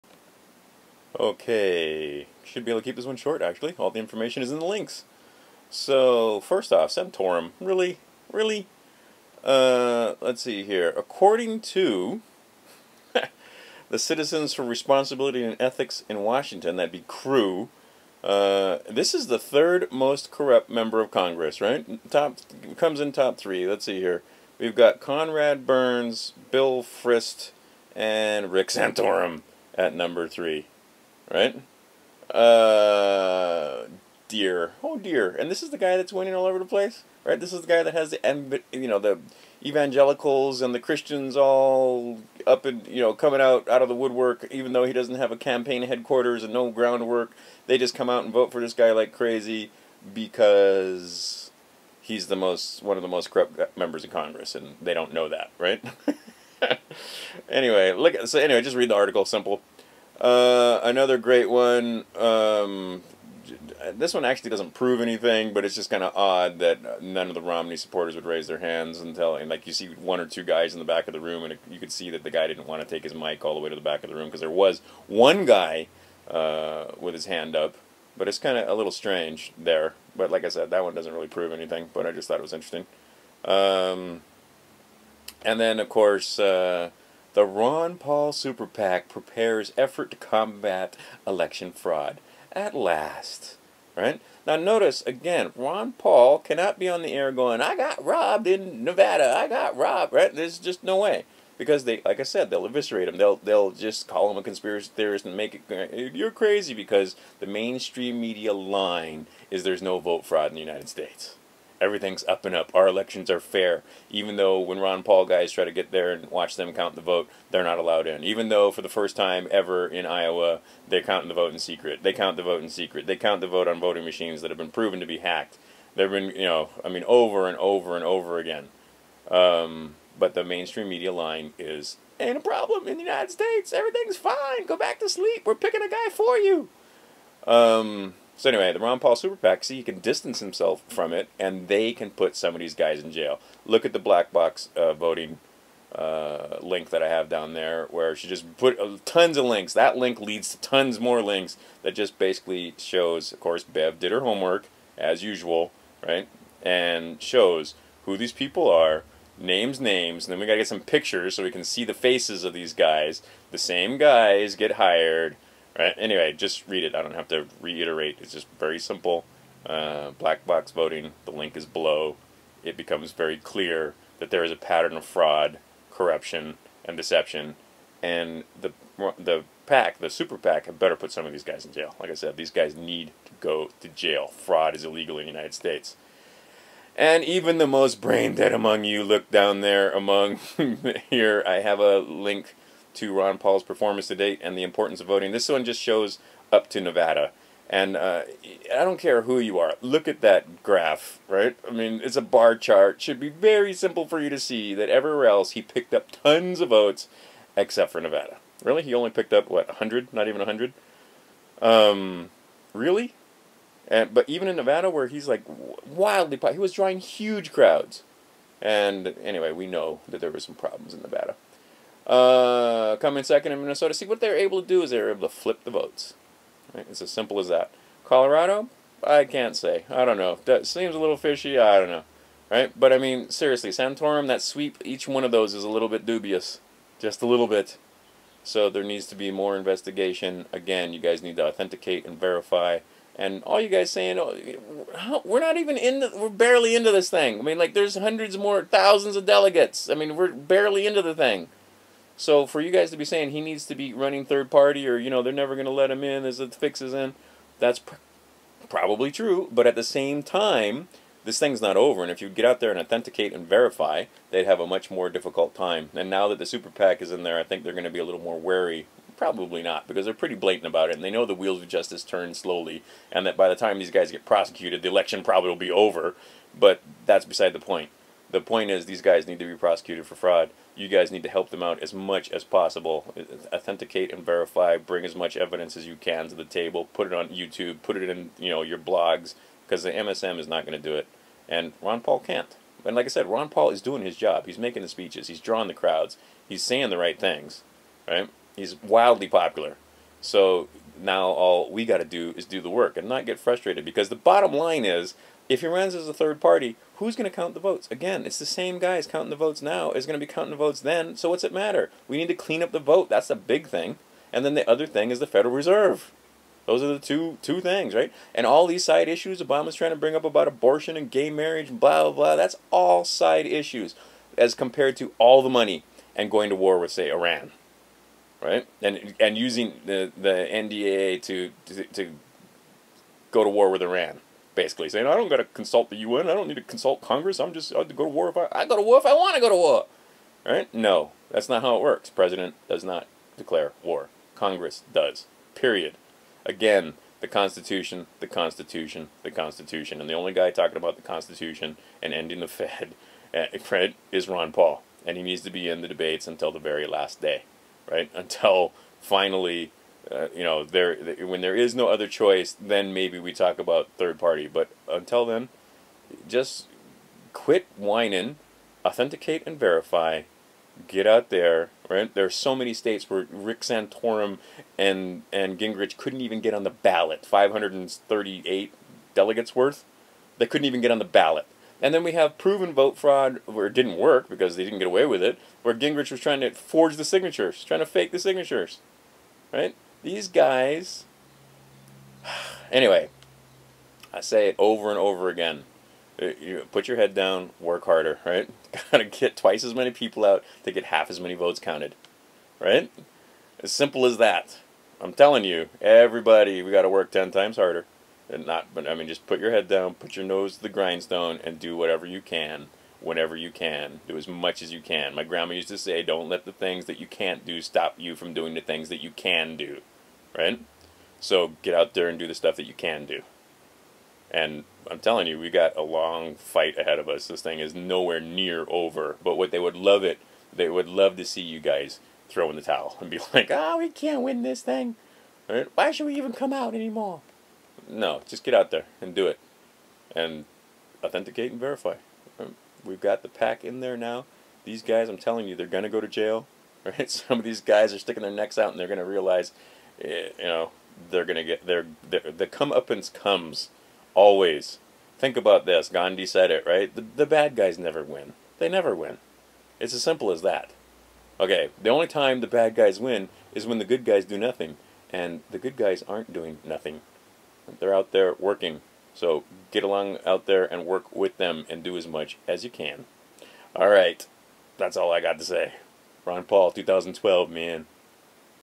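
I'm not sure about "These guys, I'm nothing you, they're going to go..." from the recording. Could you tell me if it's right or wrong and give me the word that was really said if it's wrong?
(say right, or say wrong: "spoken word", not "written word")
wrong: "telling", not "nothing".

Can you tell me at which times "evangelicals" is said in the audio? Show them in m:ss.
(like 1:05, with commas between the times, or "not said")
0:39.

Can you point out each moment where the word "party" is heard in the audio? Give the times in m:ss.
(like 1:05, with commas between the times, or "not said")
4:14, 5:06, 6:04.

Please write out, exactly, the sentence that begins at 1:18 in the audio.
But it's kind of a little strange there.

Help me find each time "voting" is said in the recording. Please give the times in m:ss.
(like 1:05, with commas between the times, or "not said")
2:03, 2:24, 2:50, 3:15.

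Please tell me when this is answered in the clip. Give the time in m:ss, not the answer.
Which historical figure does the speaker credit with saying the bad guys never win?
7:35.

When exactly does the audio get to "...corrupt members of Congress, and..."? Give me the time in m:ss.
0:53.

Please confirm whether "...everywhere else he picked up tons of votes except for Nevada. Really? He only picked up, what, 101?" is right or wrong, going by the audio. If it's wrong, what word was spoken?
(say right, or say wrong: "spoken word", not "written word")
wrong: "100", not "101".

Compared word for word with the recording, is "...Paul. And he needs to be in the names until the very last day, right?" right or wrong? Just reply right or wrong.
wrong.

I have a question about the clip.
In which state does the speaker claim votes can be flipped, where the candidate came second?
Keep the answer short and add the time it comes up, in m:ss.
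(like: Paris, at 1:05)
Minnesota, at 3:43.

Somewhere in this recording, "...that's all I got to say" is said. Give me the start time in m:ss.
7:54.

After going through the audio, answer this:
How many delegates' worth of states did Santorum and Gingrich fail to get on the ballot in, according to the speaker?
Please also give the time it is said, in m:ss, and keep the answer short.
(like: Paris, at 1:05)
538, at 6:17.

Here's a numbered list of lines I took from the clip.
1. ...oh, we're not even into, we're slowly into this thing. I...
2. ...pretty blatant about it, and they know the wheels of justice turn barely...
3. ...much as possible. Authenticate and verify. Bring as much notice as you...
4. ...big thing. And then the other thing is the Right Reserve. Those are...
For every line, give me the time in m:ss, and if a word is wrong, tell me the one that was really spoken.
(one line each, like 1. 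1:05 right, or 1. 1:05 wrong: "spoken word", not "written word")
1. 4:04 wrong: "barely", not "slowly"
2. 4:30 wrong: "slowly", not "barely"
3. 4:41 wrong: "evidence", not "notice"
4. 5:13 wrong: "Federal", not "Right".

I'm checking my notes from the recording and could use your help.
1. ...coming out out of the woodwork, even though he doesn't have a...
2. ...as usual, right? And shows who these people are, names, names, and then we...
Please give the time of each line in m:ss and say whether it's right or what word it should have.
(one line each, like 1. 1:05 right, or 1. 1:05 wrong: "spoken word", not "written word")
1. 0:43 right
2. 2:34 right.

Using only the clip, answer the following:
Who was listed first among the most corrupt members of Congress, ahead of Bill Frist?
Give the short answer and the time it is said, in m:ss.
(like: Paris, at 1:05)
Conrad Burns, at 0:24.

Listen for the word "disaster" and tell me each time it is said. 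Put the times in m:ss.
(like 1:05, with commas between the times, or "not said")
not said.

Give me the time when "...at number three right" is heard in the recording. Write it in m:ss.
0:29.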